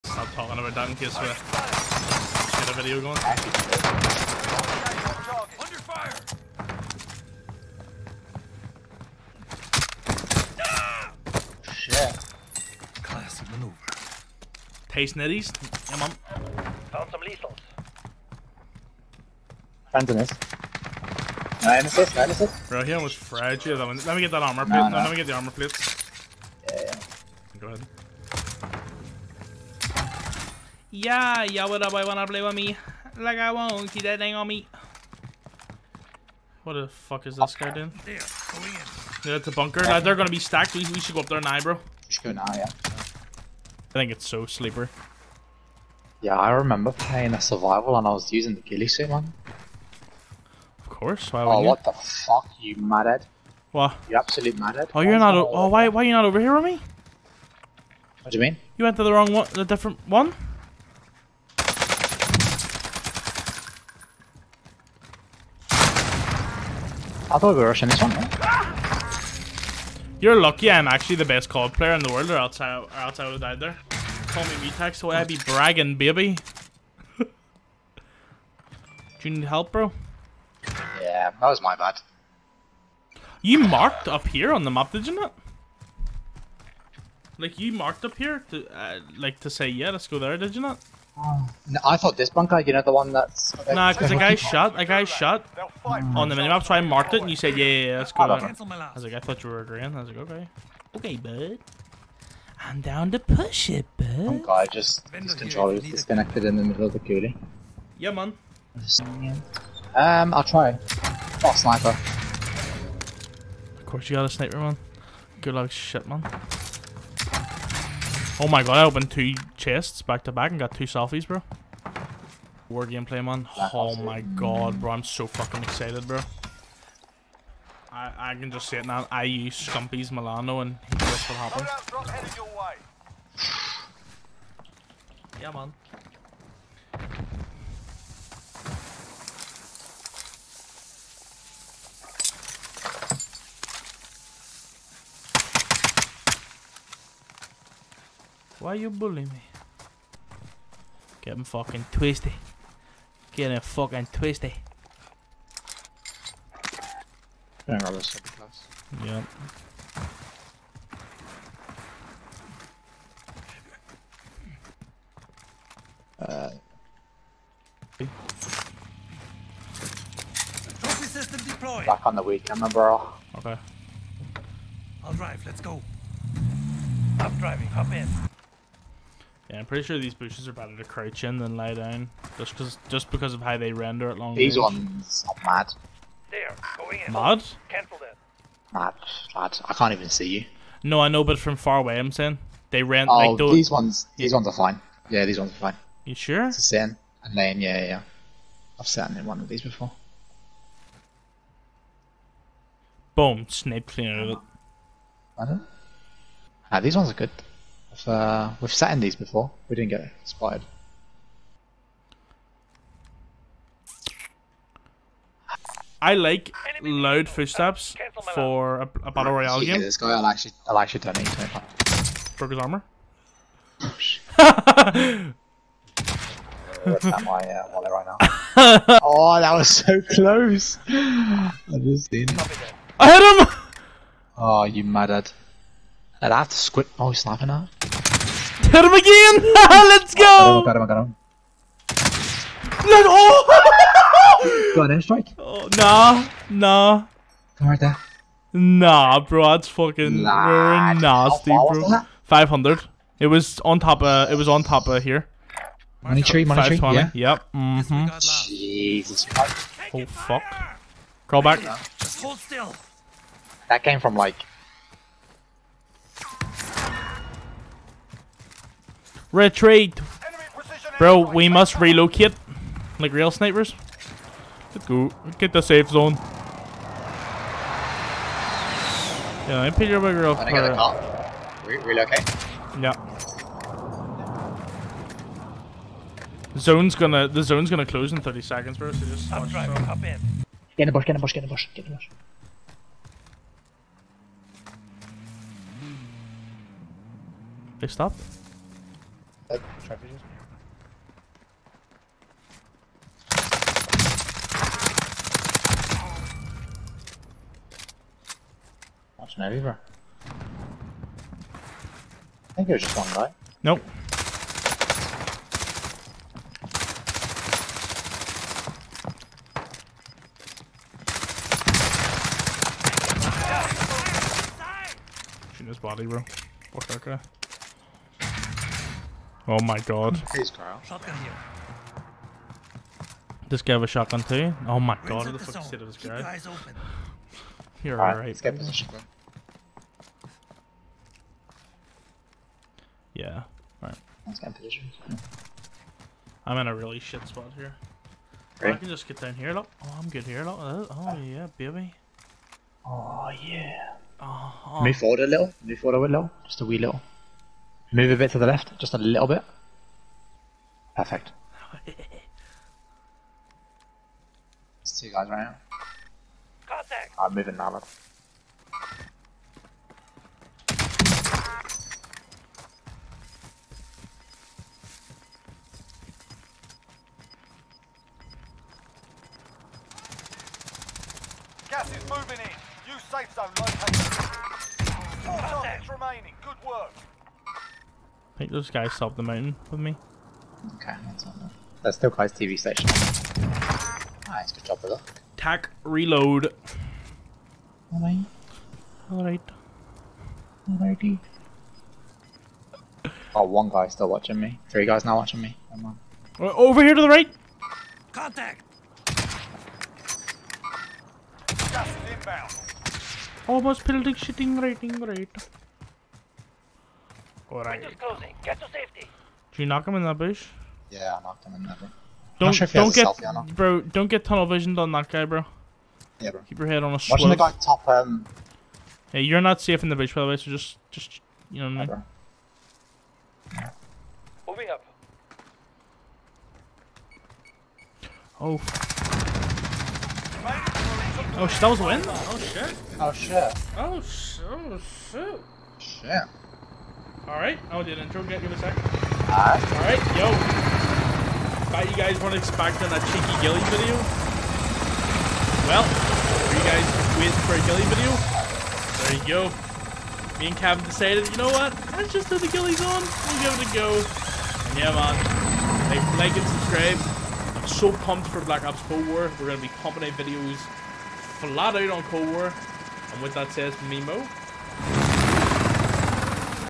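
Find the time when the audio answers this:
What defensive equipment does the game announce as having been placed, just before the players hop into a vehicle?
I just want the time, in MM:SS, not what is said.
02:50.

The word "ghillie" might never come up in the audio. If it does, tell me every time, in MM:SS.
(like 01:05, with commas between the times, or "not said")
00:48, 07:33, 07:37, 07:42.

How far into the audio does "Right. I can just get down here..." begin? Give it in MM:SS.
05:48.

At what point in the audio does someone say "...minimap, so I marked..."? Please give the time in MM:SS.
01:36.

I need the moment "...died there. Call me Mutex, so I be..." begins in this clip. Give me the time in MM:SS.
01:13.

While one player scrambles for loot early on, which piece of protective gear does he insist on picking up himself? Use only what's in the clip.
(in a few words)
armor plate.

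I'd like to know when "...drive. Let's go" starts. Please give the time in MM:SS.
02:55.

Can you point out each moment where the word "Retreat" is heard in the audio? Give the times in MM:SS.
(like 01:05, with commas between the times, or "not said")
04:29.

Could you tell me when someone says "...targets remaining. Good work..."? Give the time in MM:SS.
06:25.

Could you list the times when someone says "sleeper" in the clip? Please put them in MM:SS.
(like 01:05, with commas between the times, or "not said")
00:44.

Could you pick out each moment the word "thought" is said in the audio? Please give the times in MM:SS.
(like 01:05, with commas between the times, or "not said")
01:07, 01:31, 01:39, 07:31.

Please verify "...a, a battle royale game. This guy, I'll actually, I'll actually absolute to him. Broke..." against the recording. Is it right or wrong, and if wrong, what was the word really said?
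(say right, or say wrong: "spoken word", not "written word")
wrong: "donate", not "absolute".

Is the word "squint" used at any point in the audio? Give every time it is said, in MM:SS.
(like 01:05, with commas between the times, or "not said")
03:56.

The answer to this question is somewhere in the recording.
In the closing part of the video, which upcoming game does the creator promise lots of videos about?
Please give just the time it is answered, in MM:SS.
07:48.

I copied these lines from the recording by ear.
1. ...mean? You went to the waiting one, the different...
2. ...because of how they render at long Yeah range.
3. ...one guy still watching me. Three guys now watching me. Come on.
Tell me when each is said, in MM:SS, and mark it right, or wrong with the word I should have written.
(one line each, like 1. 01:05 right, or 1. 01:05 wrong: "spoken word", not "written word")
1. 00:58 wrong: "wrong", not "waiting"
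2. 03:03 wrong: "These", not "Yeah"
3. 06:43 right.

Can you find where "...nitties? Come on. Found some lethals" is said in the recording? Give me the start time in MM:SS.
00:15.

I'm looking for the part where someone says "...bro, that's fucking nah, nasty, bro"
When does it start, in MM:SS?
04:09.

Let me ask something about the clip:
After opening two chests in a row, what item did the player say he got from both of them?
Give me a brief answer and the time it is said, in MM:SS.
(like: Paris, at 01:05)
selfies, at 02:00.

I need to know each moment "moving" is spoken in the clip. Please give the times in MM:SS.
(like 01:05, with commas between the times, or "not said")
06:07, 06:22, 07:14.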